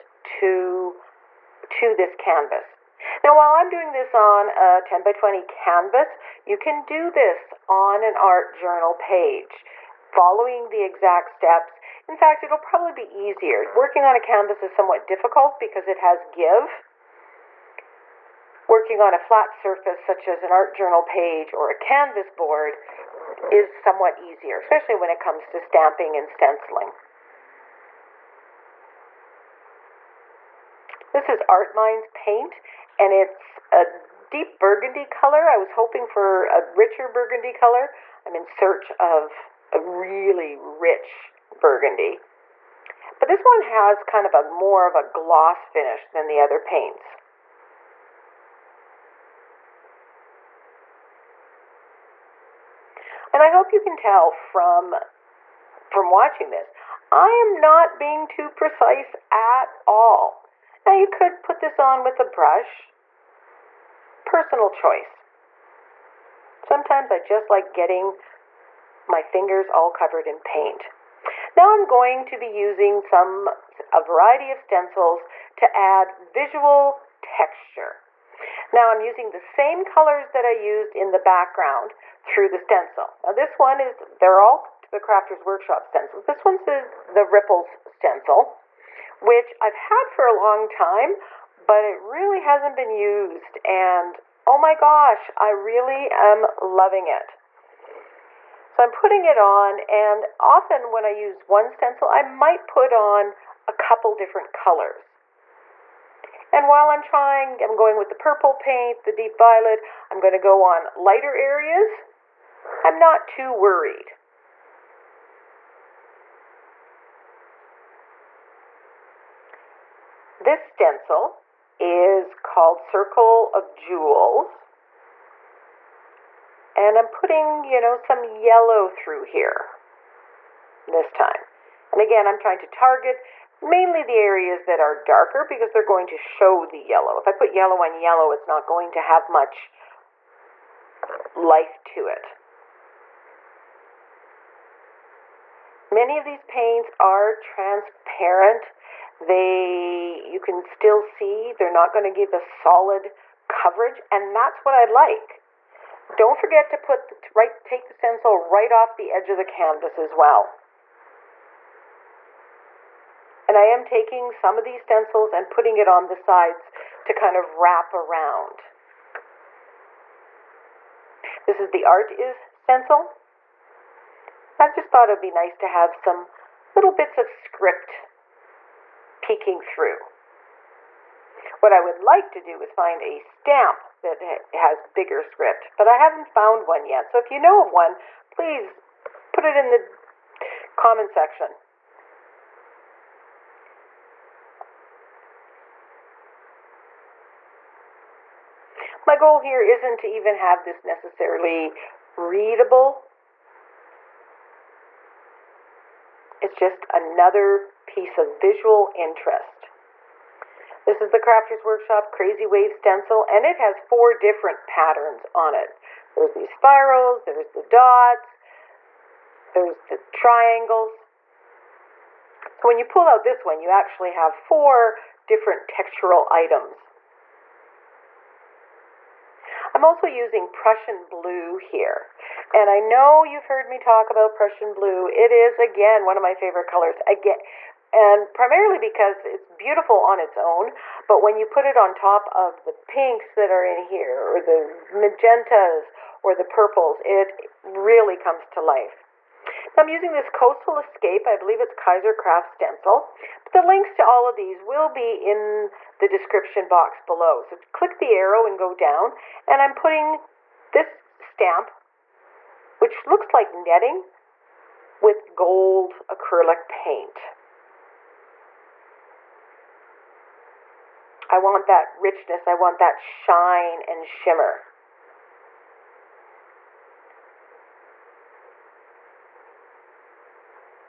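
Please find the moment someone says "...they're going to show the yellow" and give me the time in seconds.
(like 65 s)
135 s.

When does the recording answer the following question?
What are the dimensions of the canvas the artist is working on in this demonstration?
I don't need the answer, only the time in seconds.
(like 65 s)
4 s.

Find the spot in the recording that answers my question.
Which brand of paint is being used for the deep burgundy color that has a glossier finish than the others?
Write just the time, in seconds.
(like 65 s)
31 s.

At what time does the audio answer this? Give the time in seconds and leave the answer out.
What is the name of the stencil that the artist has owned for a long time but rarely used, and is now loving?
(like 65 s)
87 s.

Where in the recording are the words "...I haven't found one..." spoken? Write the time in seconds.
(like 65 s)
185 s.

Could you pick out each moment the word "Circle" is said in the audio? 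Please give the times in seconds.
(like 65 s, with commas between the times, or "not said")
122 s.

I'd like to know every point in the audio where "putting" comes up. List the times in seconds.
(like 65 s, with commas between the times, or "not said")
98 s, 127 s, 165 s, 259 s.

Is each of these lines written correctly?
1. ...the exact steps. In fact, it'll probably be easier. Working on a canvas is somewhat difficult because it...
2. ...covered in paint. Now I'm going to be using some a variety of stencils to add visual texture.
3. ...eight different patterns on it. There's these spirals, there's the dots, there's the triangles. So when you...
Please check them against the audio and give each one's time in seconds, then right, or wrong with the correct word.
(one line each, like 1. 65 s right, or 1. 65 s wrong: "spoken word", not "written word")
1. 10 s right
2. 69 s right
3. 213 s wrong: "four", not "eight".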